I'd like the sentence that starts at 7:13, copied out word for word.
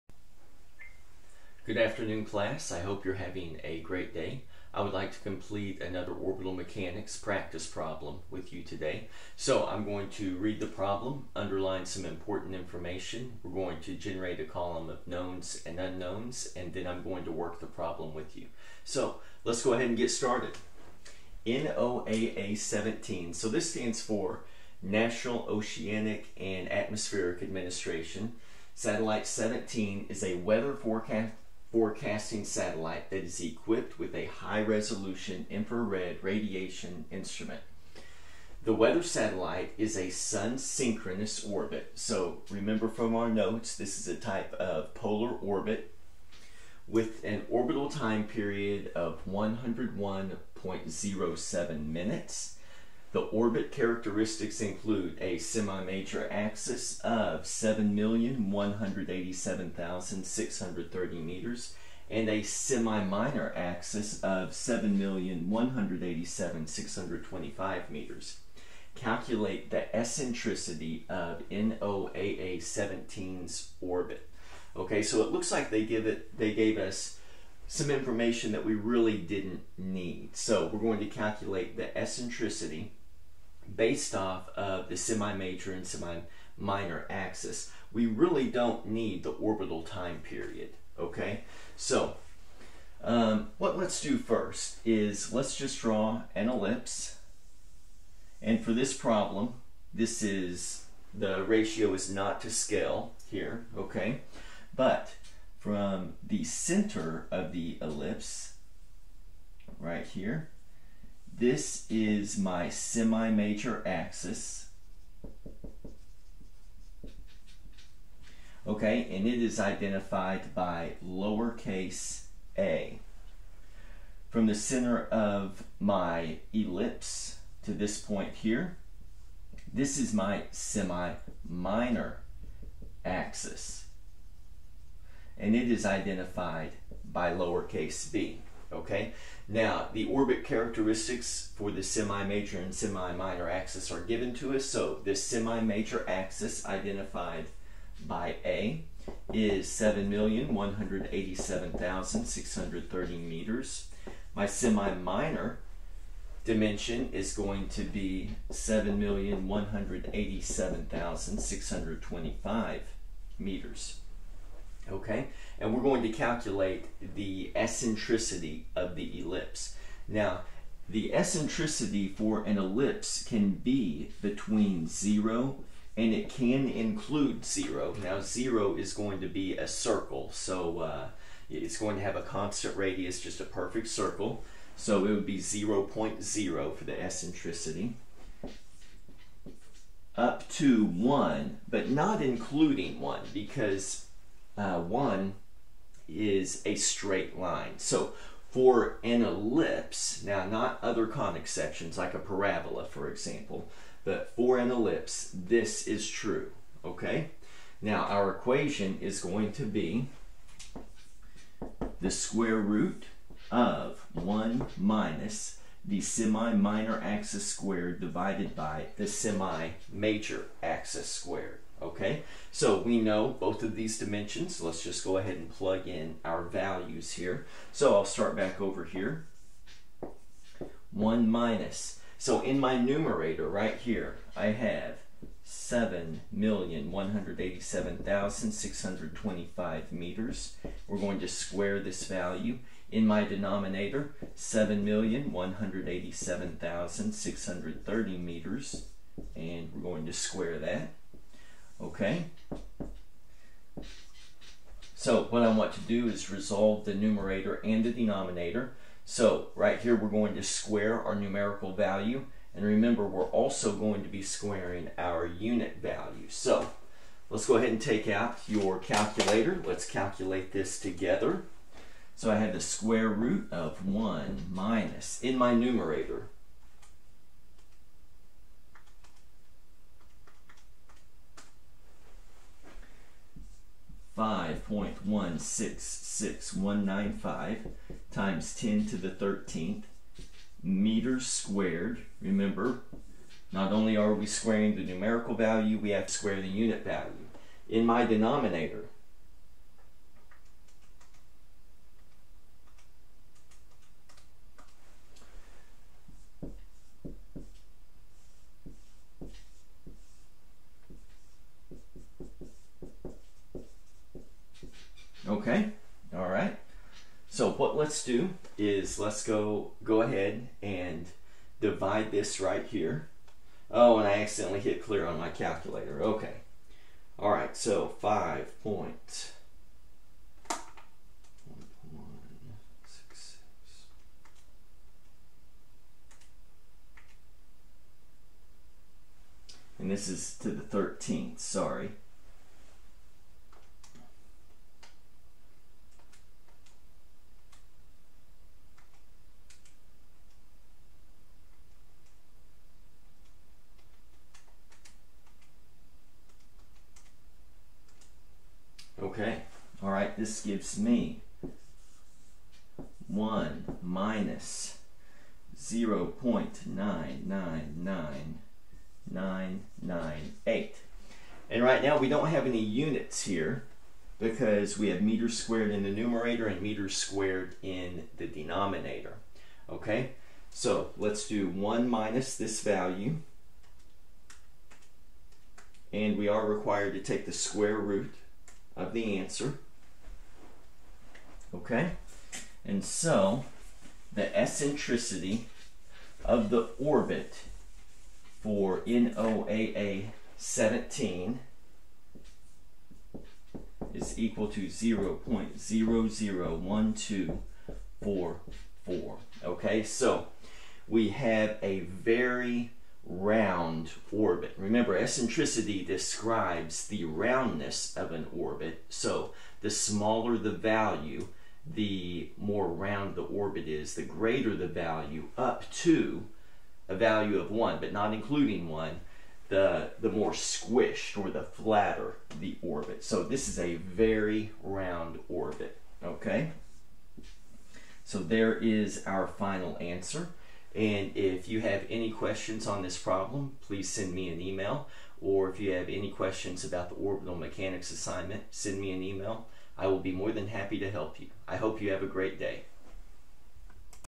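So this is a very round orbit, okay?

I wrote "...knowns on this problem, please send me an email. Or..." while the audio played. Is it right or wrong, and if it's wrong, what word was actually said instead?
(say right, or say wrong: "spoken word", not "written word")
wrong: "questions", not "knowns".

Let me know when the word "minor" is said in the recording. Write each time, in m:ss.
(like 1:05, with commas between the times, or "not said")
1:02, 1:25, 2:10, 2:22, 2:34, 3:36.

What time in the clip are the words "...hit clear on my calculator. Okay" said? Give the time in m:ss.
5:24.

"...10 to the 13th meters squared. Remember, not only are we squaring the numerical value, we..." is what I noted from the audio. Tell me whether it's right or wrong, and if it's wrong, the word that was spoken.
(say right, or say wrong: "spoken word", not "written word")
right.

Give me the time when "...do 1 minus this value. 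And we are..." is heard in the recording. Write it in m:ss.
6:21.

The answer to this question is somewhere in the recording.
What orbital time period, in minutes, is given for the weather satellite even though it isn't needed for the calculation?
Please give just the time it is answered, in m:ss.
0:49.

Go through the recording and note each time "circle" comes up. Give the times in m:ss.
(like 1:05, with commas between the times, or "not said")
2:59, 3:03.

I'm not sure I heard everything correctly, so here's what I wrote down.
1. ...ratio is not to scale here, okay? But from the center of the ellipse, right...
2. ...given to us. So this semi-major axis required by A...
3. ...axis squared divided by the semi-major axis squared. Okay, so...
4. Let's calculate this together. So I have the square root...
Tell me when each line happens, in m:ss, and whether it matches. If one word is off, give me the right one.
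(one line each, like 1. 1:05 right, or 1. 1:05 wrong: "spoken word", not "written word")
1. 1:41 right
2. 2:24 wrong: "identified", not "required"
3. 3:37 right
4. 4:29 right.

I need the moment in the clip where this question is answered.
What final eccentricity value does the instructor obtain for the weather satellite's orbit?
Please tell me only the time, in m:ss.
6:45.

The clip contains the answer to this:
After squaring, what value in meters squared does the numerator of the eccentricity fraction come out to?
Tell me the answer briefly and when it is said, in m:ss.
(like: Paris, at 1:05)
5.166195 × 10^13 m², at 4:44.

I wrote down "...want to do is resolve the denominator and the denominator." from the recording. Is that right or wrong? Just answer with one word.
wrong.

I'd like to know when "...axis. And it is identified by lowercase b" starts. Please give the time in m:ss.
2:13.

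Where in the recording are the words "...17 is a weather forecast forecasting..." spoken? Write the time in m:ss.
0:29.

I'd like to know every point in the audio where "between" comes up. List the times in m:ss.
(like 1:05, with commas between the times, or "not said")
2:54.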